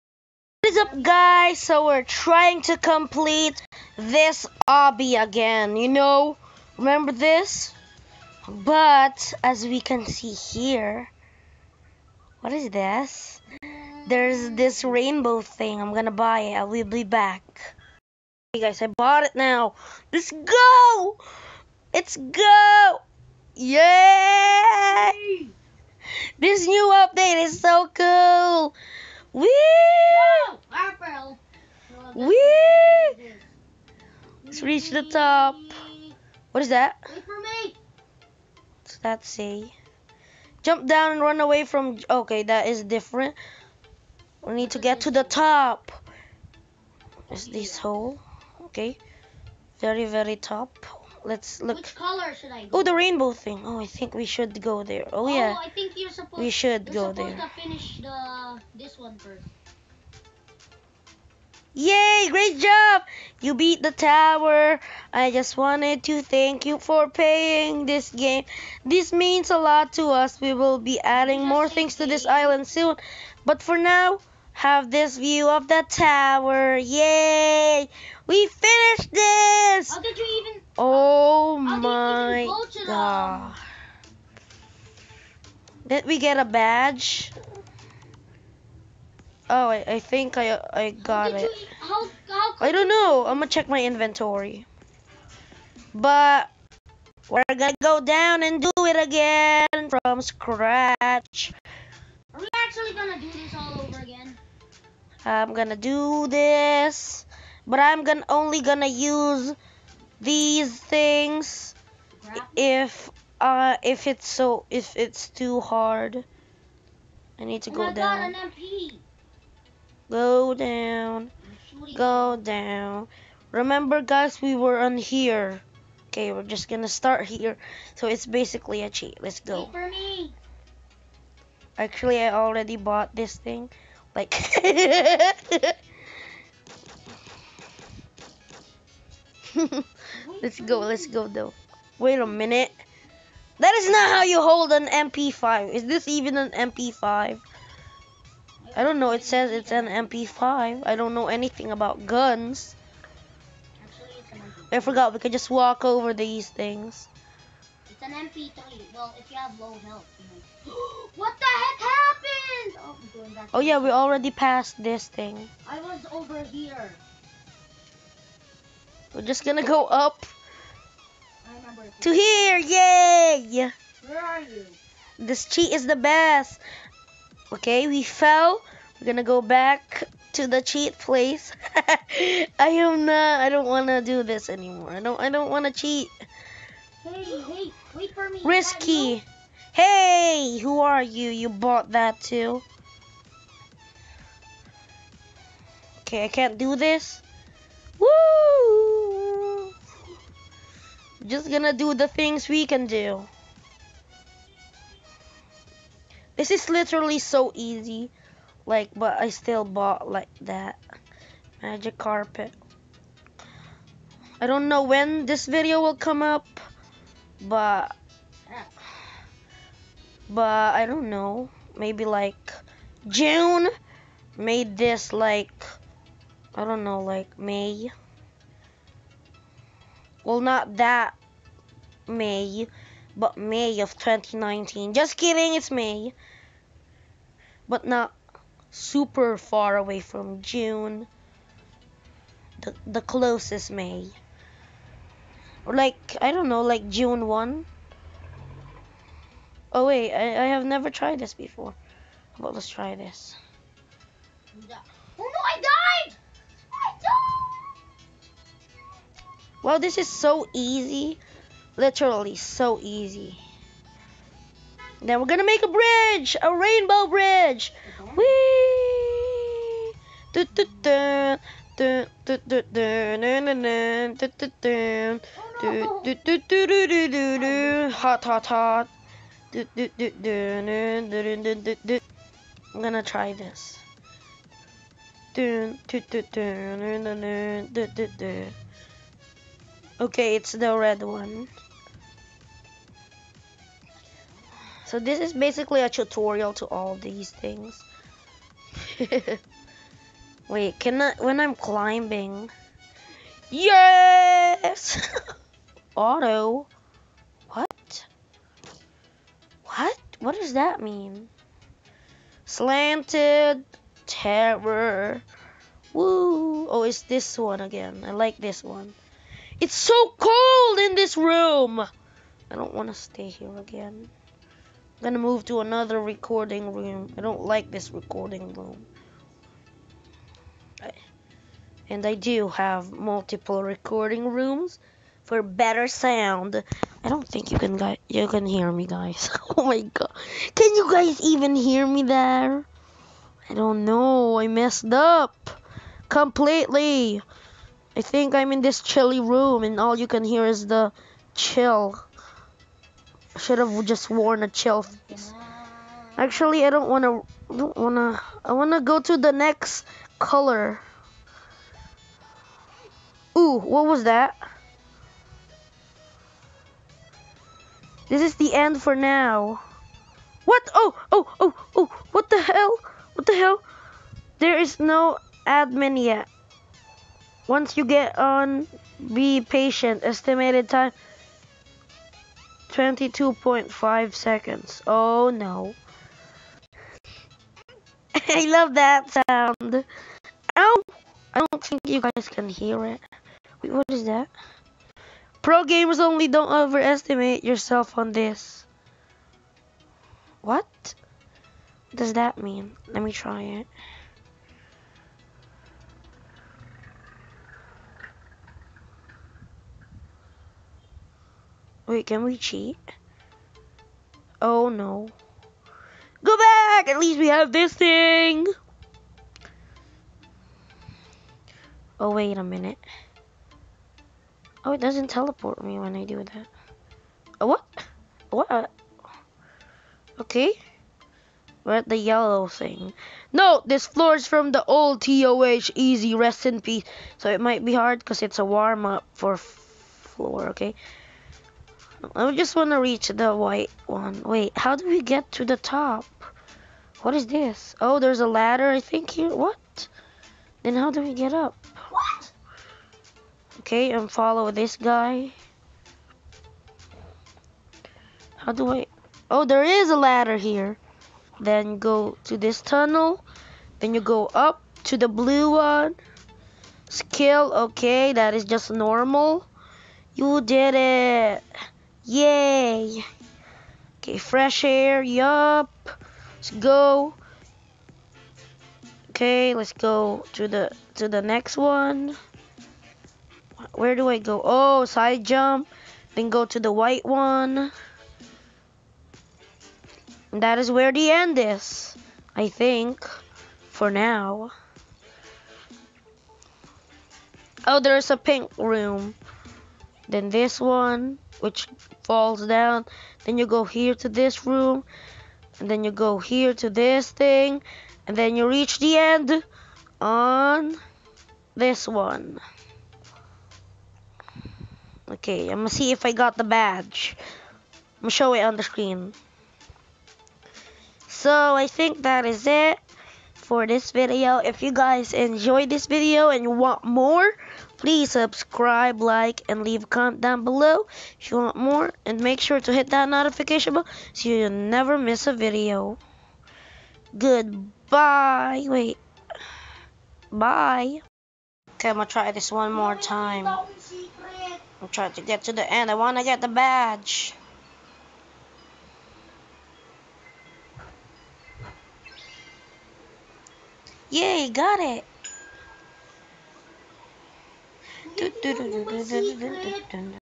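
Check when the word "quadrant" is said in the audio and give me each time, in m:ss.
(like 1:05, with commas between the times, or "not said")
not said.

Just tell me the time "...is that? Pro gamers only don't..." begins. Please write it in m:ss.
6:33.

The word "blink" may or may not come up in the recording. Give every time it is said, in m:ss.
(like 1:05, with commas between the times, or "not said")
not said.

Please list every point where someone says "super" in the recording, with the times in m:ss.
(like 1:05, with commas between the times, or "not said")
3:58.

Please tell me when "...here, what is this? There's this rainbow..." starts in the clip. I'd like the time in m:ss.
0:10.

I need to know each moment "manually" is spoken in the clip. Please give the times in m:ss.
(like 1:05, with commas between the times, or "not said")
not said.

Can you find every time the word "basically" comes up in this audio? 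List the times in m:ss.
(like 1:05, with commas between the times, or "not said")
2:08, 4:55.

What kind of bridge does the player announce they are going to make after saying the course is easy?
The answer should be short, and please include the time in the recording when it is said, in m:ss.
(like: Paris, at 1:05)
rainbow bridge, at 4:26.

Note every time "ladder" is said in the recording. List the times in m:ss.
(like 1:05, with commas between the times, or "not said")
7:28, 7:39.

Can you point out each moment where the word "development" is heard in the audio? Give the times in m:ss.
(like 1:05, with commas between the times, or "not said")
not said.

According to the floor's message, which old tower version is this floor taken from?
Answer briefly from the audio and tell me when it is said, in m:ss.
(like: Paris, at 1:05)
TOH Easy, at 7:15.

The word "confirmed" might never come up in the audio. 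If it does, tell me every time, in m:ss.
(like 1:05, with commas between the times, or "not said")
not said.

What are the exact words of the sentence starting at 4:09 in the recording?
Oh wait, I, I have never tried this before.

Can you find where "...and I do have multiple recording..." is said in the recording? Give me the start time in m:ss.
5:31.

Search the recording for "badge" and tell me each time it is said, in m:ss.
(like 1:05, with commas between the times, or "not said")
1:26, 8:36, 9:06.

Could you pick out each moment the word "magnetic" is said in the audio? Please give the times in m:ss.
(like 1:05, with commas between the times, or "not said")
not said.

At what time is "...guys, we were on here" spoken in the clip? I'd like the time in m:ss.
2:04.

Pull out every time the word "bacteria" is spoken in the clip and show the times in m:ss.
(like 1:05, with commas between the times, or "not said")
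not said.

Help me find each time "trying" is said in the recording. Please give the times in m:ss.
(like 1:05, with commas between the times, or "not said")
0:02, 9:04.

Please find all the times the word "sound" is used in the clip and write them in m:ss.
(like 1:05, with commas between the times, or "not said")
5:35, 6:29.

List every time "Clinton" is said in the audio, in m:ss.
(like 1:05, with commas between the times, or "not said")
not said.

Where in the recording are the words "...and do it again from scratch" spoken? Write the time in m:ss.
1:38.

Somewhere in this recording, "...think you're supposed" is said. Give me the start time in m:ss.
0:55.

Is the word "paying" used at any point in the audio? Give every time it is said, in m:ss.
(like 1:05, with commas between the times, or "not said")
1:07.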